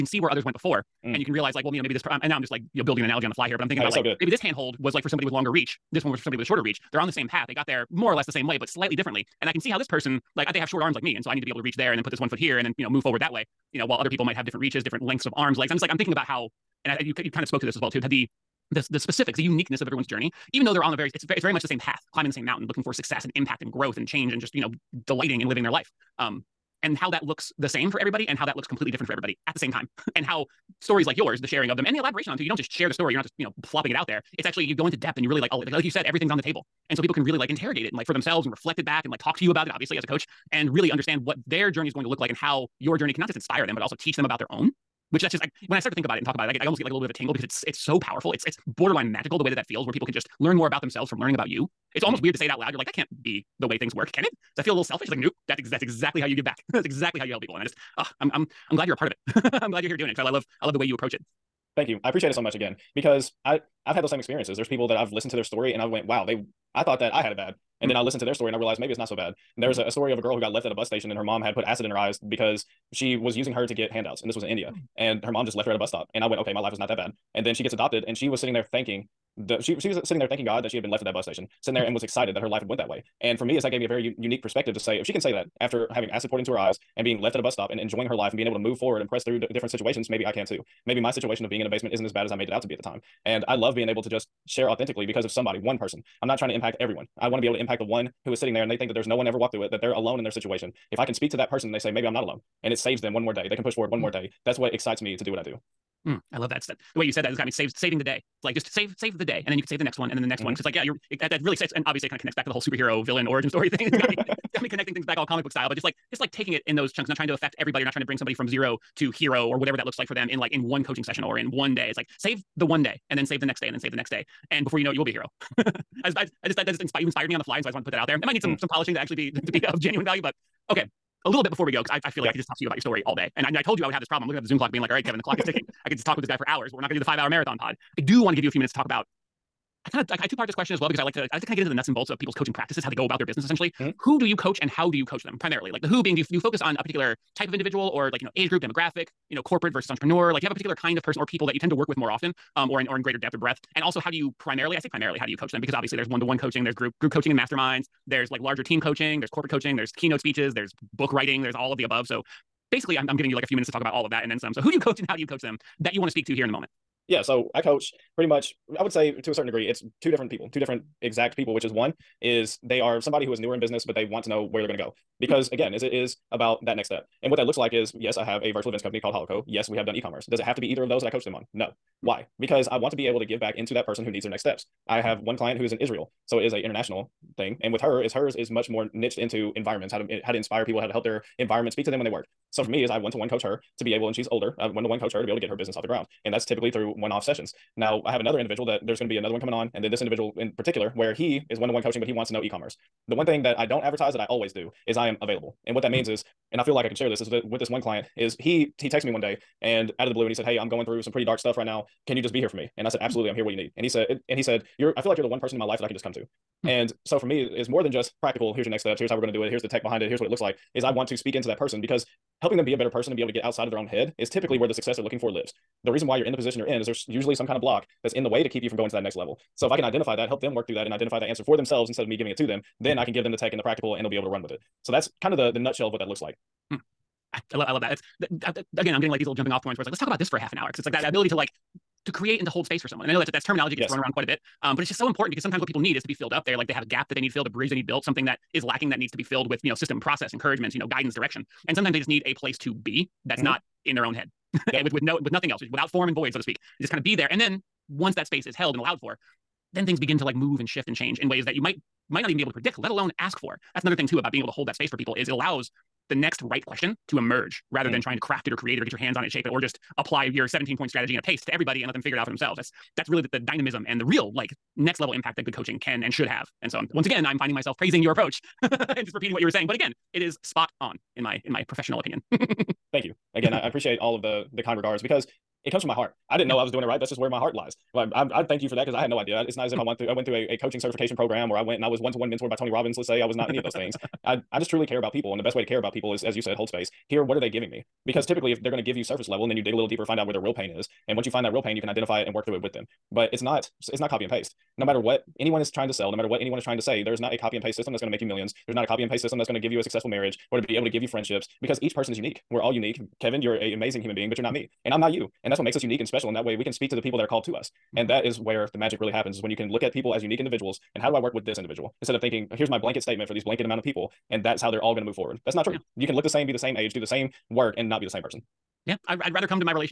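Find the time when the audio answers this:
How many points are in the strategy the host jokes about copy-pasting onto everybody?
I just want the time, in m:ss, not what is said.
4:30.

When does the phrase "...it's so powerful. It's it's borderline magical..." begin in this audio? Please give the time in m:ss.
0:47.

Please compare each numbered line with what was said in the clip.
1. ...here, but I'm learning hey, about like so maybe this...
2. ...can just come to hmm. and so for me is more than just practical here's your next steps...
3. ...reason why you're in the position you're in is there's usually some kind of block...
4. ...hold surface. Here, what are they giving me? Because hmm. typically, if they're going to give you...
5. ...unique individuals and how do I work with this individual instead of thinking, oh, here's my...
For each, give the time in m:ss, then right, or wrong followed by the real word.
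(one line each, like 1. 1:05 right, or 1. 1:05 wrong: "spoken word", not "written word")
1. 0:03 wrong: "thinking", not "learning"
2. 3:35 right
3. 3:45 right
4. 4:56 wrong: "space", not "surface"
5. 5:20 right.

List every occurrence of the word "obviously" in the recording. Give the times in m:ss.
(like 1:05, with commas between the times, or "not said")
0:39, 1:51, 2:35.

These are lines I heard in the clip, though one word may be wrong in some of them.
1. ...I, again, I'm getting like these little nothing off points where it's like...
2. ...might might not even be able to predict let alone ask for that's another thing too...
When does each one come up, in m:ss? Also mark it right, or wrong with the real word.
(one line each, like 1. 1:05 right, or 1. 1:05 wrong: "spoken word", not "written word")
1. 3:58 wrong: "jumping", not "nothing"
2. 4:21 right.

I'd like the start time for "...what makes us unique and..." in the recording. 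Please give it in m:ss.
5:15.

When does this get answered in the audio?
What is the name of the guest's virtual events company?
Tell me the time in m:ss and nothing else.
2:59.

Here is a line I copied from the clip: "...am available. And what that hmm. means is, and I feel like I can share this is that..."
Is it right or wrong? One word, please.
right.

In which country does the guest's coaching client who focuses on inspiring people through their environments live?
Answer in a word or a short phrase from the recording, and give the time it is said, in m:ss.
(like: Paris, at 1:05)
Israel, at 3:05.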